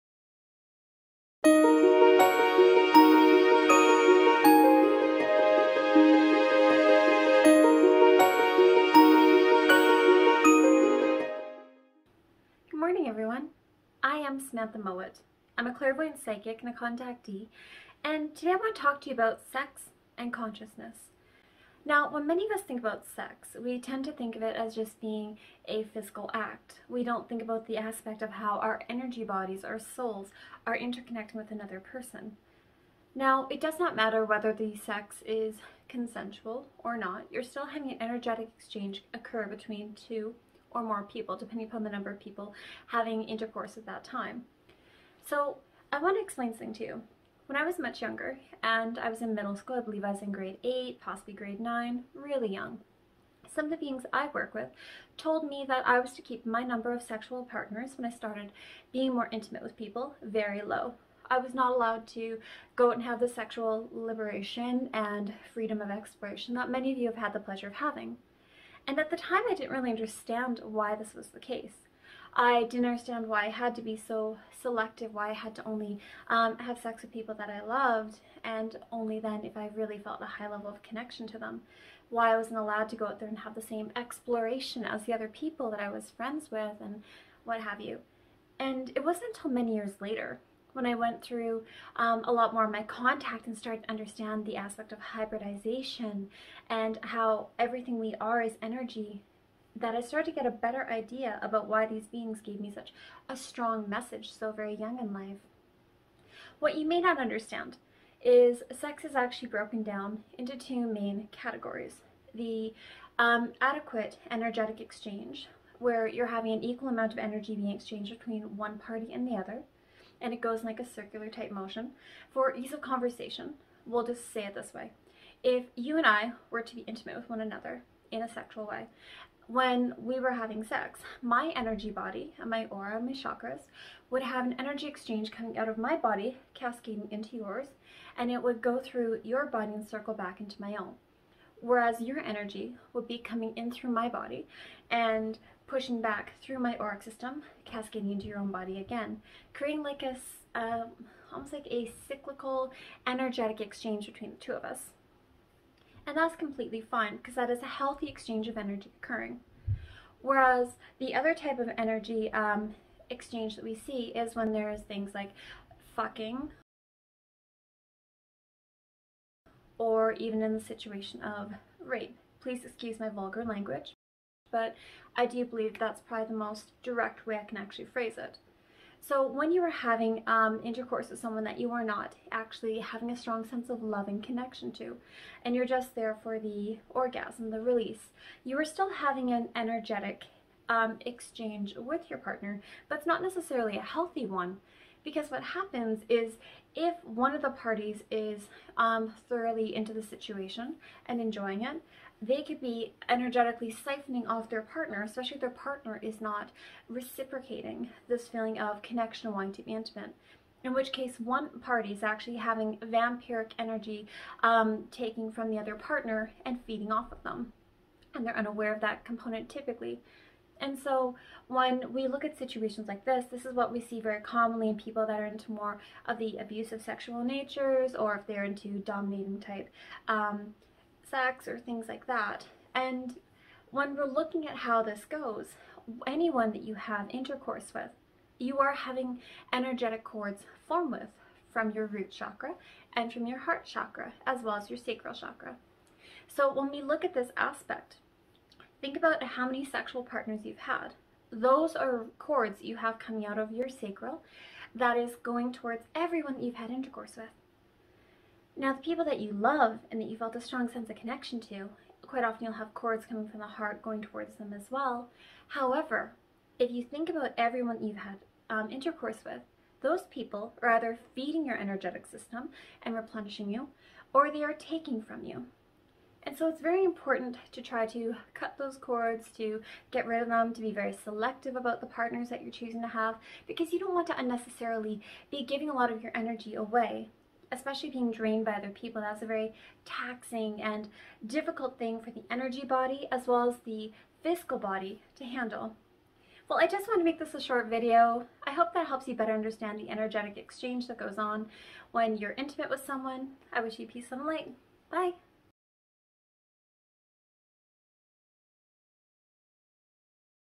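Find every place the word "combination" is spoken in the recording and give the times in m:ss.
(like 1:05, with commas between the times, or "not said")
not said.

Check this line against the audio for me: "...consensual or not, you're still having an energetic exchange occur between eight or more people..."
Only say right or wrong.
wrong.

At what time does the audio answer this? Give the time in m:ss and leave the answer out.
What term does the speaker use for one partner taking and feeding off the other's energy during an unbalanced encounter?
3:32.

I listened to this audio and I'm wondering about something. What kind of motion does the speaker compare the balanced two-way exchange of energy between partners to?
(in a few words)
circular.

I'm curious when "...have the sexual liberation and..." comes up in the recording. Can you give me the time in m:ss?
1:03.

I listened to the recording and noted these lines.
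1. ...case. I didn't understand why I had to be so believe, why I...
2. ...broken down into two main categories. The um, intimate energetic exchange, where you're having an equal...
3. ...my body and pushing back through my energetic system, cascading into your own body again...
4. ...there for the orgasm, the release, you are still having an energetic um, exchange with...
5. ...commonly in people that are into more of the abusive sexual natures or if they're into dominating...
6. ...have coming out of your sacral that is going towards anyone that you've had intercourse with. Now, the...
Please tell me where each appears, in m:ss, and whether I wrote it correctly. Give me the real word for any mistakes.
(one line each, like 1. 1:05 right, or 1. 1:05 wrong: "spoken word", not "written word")
1. 1:11 wrong: "selective", not "believe"
2. 1:49 wrong: "adequate", not "intimate"
3. 2:23 wrong: "auric", not "energetic"
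4. 3:05 right
5. 3:44 right
6. 4:12 wrong: "everyone", not "anyone".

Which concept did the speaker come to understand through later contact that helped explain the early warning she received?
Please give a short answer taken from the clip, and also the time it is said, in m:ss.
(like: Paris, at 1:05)
hybridization, at 1:34.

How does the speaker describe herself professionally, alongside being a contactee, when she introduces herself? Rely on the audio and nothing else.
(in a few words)
clairvoyant psychic.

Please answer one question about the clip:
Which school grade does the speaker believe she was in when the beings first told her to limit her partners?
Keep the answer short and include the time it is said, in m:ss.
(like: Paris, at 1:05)
grade 8, at 0:50.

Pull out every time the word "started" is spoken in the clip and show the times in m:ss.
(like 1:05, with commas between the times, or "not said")
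0:58, 1:33, 1:40.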